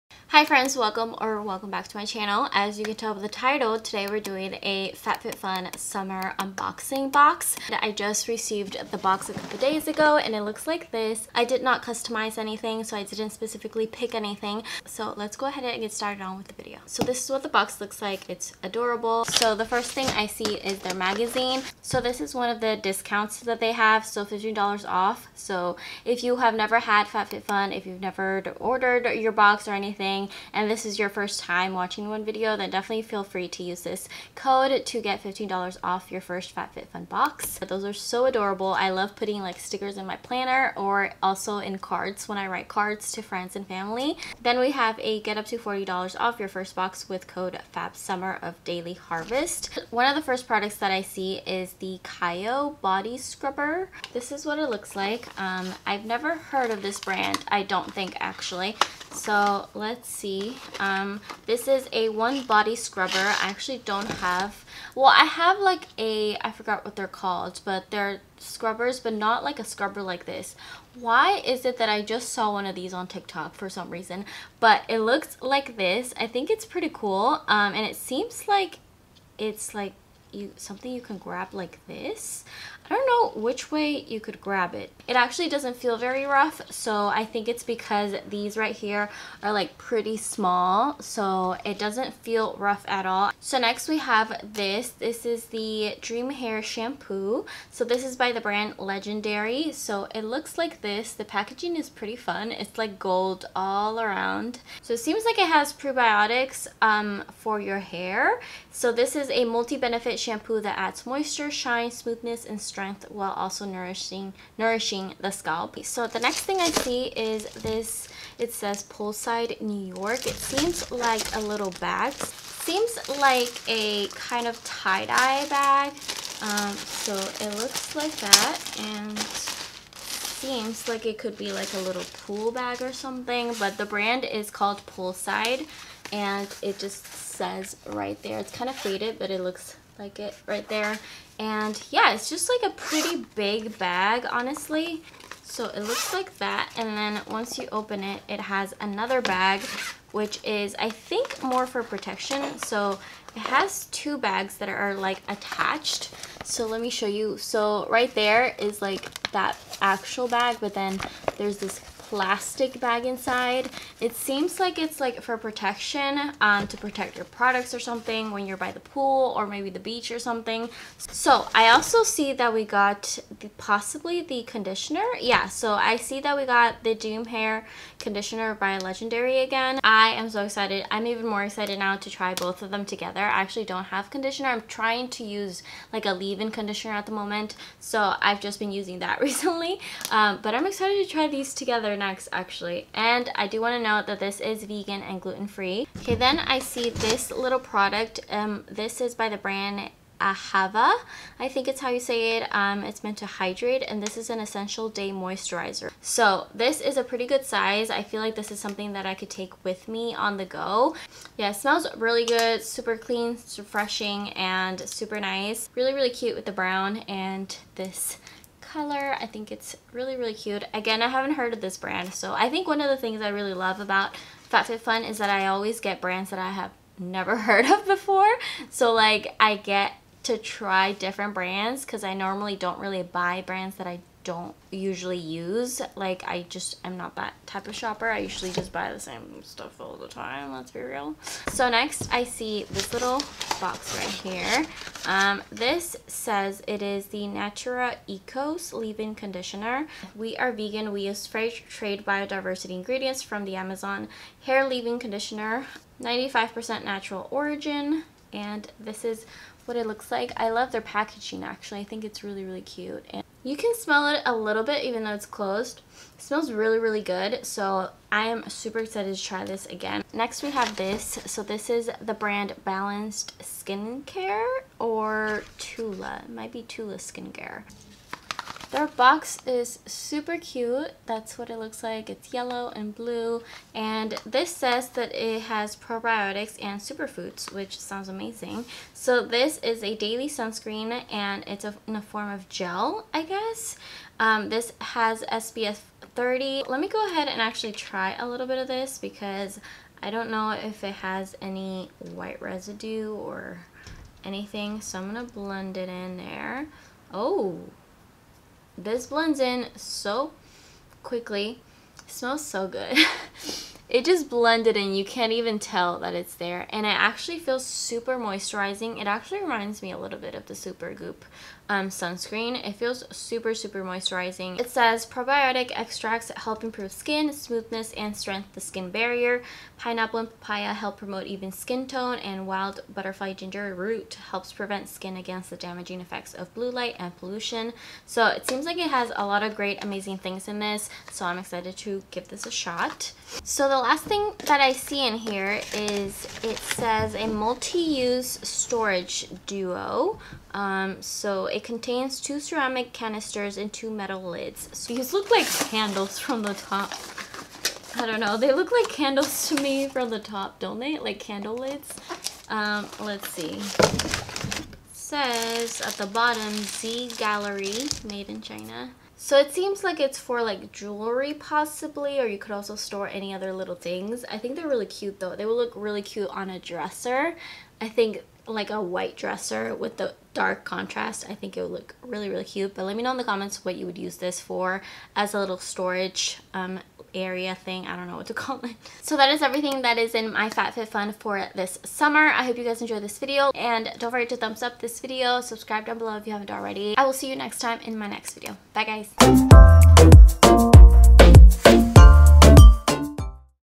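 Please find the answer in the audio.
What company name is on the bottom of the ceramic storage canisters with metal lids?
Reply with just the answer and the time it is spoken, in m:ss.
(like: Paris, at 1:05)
Z Gallerie, at 6:06.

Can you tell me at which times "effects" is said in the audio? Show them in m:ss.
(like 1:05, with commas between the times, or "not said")
5:36.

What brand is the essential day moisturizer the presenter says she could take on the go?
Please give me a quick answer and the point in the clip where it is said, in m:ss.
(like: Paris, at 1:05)
Ahava, at 3:20.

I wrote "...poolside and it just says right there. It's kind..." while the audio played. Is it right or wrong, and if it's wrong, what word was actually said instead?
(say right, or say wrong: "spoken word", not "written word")
right.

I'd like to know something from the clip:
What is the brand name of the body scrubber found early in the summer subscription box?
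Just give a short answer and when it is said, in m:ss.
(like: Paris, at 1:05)
Kayo, at 0:52.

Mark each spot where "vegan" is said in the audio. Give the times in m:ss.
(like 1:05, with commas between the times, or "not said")
3:14, 4:10.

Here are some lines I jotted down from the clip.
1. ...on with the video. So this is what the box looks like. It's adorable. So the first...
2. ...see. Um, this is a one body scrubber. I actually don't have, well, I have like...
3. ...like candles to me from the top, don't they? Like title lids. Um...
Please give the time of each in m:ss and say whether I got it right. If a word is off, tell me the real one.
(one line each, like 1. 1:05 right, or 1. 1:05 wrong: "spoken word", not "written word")
1. 0:16 right
2. 1:00 right
3. 5:58 wrong: "candle", not "title".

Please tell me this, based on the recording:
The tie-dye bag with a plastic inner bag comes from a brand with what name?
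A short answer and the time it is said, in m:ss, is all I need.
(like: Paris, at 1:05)
Poolside New York, at 1:58.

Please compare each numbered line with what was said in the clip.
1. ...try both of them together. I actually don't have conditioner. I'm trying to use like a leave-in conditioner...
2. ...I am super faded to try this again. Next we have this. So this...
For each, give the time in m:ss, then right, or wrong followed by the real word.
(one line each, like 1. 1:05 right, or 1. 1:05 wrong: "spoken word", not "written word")
1. 3:02 right
2. 4:28 wrong: "excited", not "faded".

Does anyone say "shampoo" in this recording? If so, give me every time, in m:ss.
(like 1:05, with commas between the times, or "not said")
1:36, 1:50.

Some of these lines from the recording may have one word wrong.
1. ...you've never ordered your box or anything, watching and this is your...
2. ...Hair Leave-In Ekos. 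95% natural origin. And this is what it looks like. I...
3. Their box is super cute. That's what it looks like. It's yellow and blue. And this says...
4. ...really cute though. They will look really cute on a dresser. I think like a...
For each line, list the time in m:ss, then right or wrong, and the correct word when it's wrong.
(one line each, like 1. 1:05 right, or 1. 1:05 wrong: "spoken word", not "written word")
1. 0:27 right
2. 4:14 wrong: "Conditioner", not "Ekos"
3. 4:38 right
4. 6:14 right.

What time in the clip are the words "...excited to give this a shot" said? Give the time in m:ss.
5:41.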